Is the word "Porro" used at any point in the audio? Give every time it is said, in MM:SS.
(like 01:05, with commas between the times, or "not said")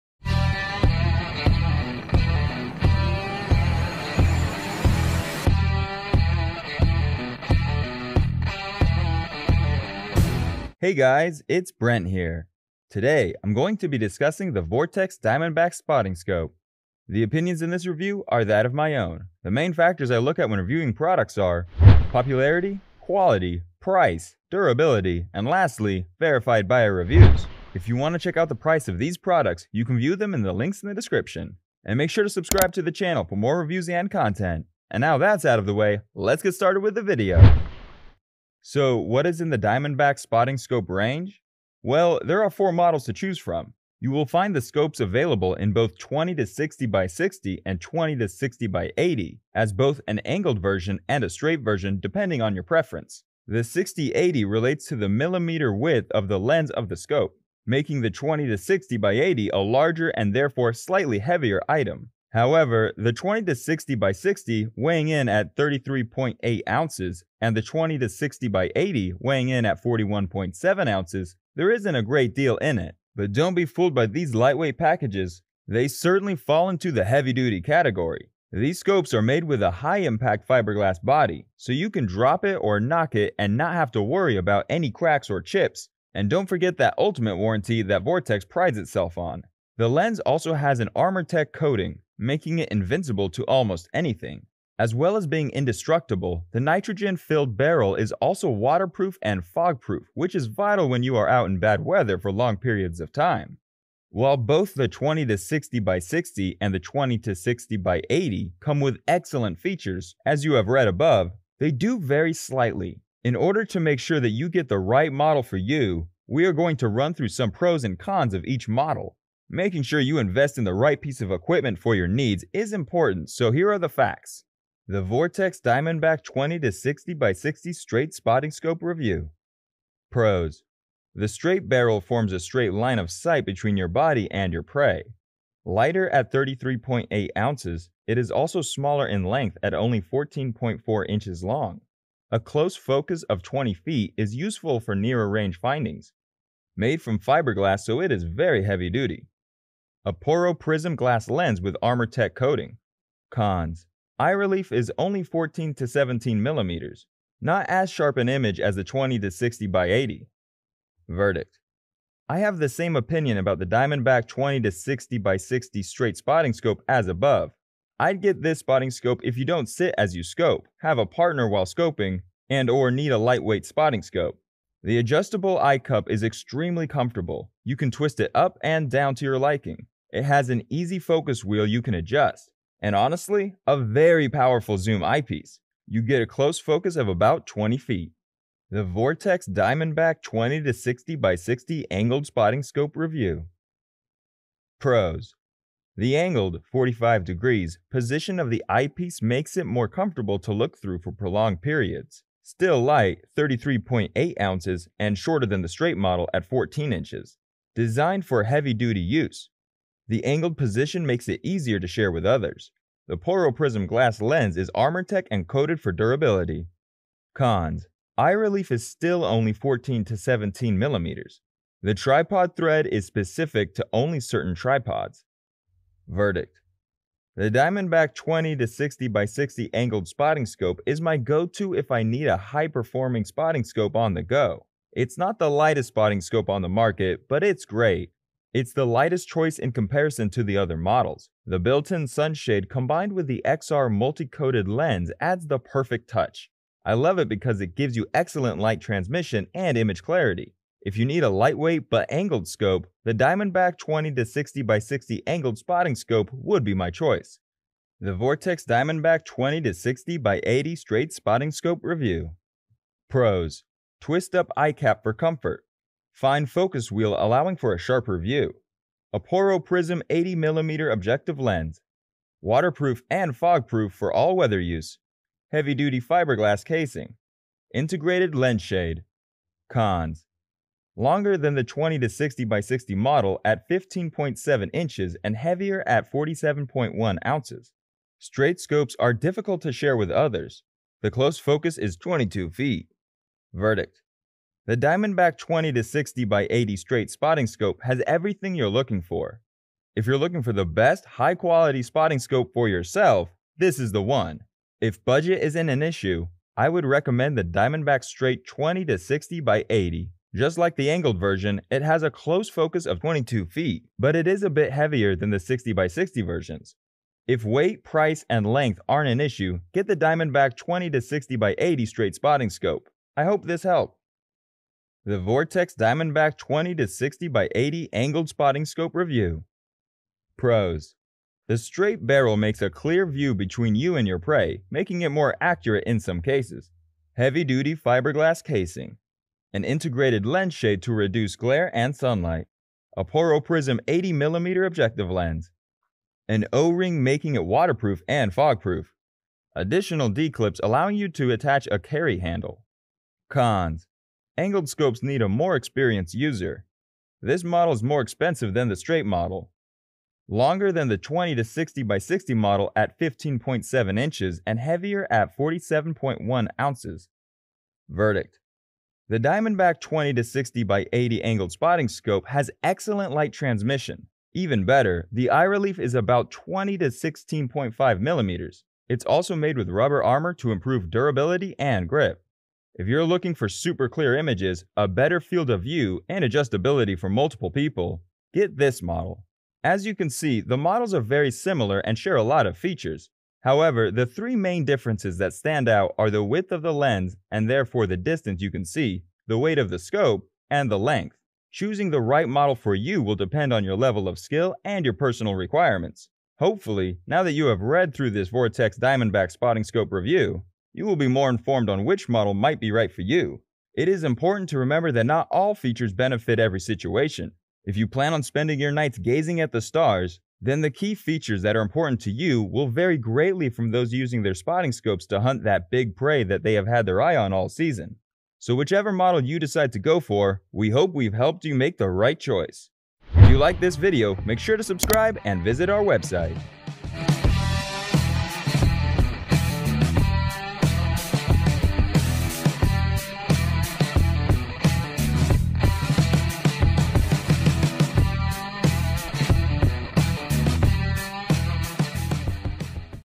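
02:30, 03:33, 04:29, 05:43.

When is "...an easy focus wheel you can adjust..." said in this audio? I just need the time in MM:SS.
03:00.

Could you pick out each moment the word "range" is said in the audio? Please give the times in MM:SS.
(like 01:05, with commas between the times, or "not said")
00:40, 02:25.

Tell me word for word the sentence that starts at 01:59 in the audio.
Making sure you invest in the right piece of equipment for your needs is important, so here are the facts.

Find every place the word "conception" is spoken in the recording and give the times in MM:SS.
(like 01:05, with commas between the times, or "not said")
not said.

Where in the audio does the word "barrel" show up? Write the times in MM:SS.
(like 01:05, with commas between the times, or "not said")
01:37, 02:11, 05:32.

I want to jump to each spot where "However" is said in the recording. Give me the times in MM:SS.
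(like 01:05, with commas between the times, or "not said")
01:02, 06:33.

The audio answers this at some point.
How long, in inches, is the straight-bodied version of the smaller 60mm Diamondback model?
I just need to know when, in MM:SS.
02:19.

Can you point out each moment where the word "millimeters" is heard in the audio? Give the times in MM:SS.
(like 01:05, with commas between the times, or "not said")
00:55, 02:36, 03:40, 06:17.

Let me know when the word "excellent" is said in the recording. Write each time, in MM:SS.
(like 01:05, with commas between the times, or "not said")
01:49, 04:08, 06:12.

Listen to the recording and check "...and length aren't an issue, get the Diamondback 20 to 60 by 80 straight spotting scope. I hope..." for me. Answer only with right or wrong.
right.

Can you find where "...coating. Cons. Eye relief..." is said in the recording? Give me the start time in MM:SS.
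02:32.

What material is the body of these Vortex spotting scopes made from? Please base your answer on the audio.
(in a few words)
high impact fiberglass.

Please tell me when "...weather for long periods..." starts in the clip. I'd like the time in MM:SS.
01:41.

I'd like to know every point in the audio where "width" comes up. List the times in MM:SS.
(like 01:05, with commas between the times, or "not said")
00:55, 06:36.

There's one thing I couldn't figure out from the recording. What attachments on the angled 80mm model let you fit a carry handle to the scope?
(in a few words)
D-clips.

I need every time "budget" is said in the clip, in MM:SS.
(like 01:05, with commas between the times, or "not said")
05:05.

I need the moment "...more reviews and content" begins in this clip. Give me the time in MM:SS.
00:33.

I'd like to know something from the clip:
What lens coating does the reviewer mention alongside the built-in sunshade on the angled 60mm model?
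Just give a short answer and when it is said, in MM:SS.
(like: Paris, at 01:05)
XR multi-coated, at 04:03.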